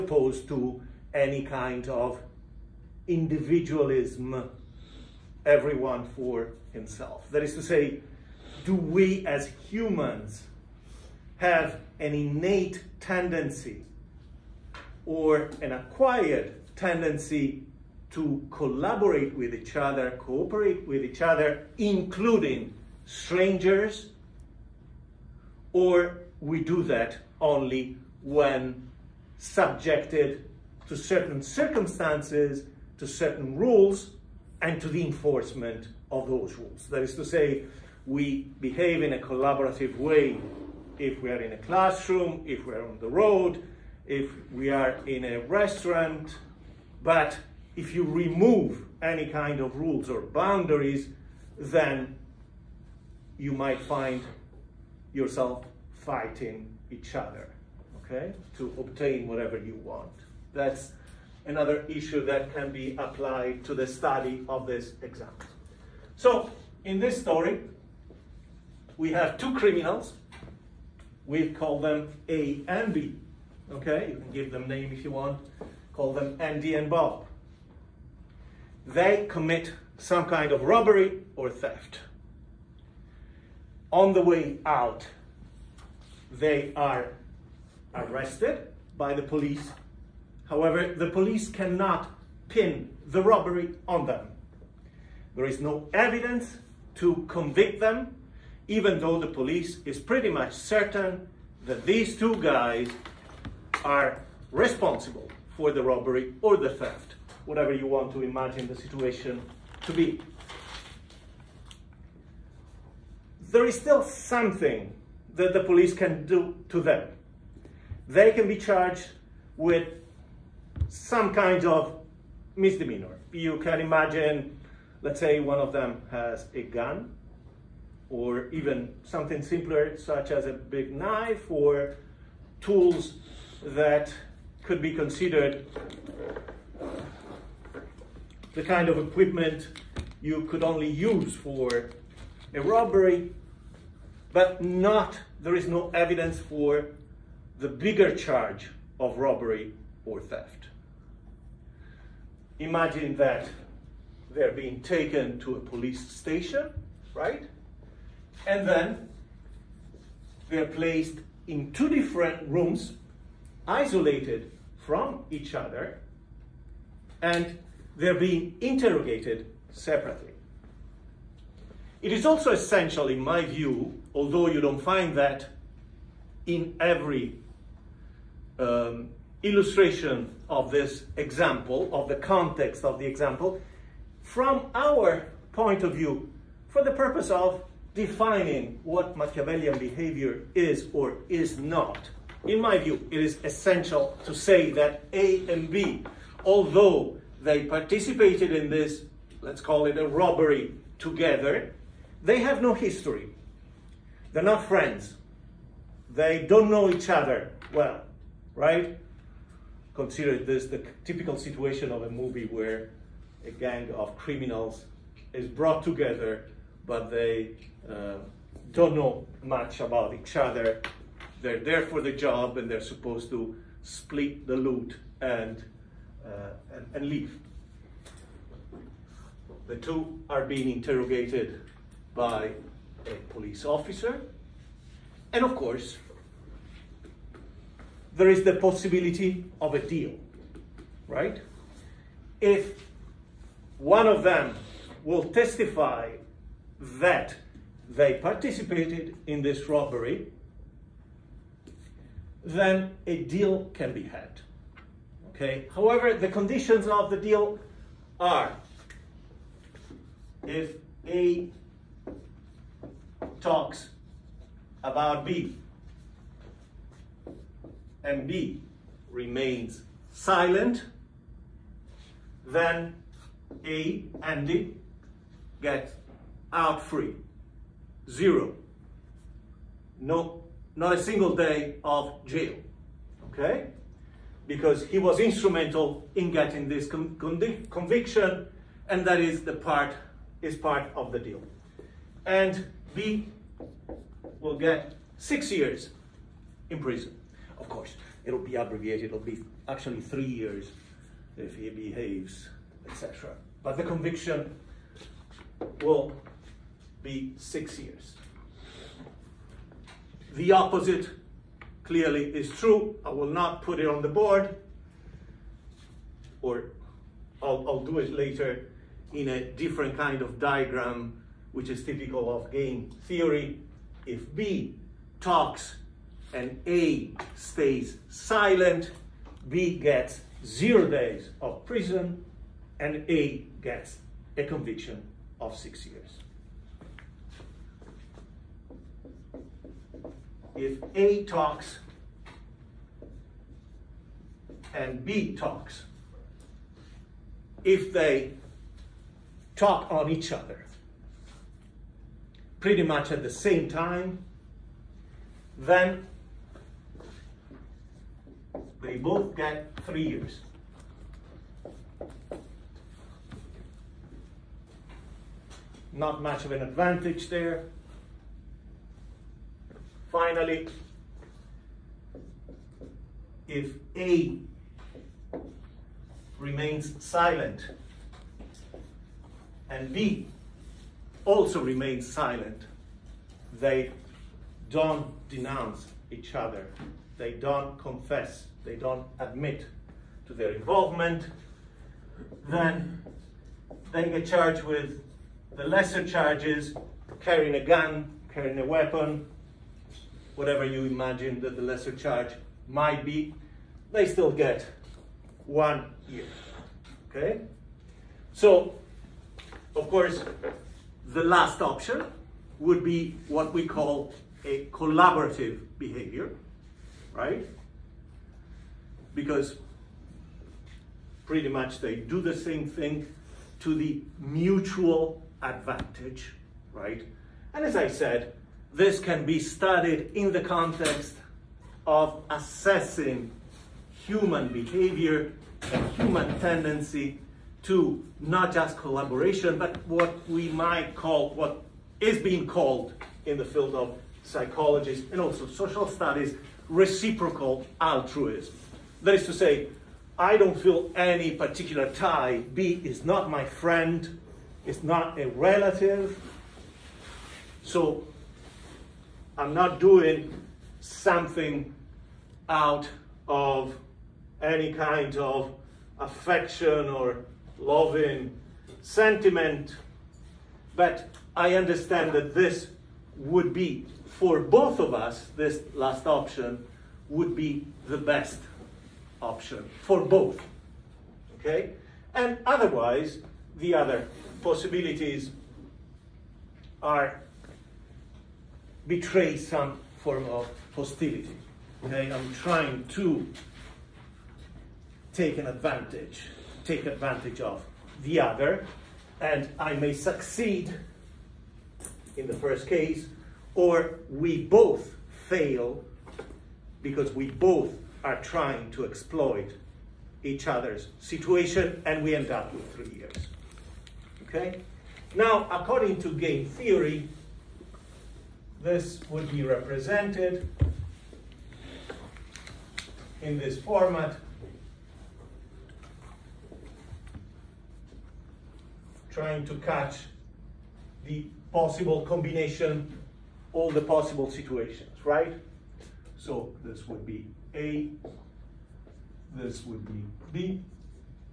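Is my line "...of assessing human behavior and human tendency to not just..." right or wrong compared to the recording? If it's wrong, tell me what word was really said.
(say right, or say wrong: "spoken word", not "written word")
right.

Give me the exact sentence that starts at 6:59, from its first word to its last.
Because pretty much they do the same thing to the mutual advantage, right?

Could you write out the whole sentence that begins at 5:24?
If B talks and A stays silent, B gets zero days of prison and A gets a conviction of six years.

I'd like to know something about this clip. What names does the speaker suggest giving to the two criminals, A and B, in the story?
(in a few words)
Andy and Bob.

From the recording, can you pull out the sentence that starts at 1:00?
That's another issue that can be applied to the study of this example.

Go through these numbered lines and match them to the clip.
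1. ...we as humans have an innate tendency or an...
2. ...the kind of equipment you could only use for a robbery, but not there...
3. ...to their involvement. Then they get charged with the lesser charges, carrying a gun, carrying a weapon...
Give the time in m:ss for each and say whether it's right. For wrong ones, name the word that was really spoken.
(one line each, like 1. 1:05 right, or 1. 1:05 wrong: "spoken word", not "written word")
1. 0:08 right
2. 2:18 right
3. 6:30 right.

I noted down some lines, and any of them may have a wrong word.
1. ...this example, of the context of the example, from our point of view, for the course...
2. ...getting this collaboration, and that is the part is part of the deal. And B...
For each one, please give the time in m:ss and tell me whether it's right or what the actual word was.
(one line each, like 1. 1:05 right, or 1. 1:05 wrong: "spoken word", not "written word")
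1. 3:00 wrong: "purpose", not "course"
2. 4:46 wrong: "conviction", not "collaboration".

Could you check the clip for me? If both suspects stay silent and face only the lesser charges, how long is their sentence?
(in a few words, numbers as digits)
1 year.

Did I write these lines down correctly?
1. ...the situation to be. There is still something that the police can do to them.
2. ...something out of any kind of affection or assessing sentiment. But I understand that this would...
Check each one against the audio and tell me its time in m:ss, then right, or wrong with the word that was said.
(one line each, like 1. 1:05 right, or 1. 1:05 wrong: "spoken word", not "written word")
1. 1:48 right
2. 7:40 wrong: "loving", not "assessing".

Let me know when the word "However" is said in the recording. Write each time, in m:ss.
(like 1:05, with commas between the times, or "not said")
1:30, 4:15.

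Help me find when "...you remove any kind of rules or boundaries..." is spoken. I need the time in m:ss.
0:47.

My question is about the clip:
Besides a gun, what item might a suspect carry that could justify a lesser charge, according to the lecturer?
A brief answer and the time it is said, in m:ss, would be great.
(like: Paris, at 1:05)
a big knife, at 2:10.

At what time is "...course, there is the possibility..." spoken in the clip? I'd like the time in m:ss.
3:55.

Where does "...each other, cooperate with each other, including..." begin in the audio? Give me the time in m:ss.
0:19.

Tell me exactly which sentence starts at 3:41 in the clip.
They're there for the job and they're supposed to split the loot and, uh, and, and leave.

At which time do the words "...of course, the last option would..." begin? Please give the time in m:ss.
6:49.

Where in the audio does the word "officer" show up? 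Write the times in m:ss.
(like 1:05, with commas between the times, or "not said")
3:53.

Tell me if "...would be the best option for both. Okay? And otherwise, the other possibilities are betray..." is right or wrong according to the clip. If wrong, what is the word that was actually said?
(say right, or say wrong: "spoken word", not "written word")
right.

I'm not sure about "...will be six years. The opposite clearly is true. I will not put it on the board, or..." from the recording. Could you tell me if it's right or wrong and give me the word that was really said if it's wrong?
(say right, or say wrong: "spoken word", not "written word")
right.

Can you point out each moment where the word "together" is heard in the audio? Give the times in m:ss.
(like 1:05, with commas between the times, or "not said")
3:20, 3:35.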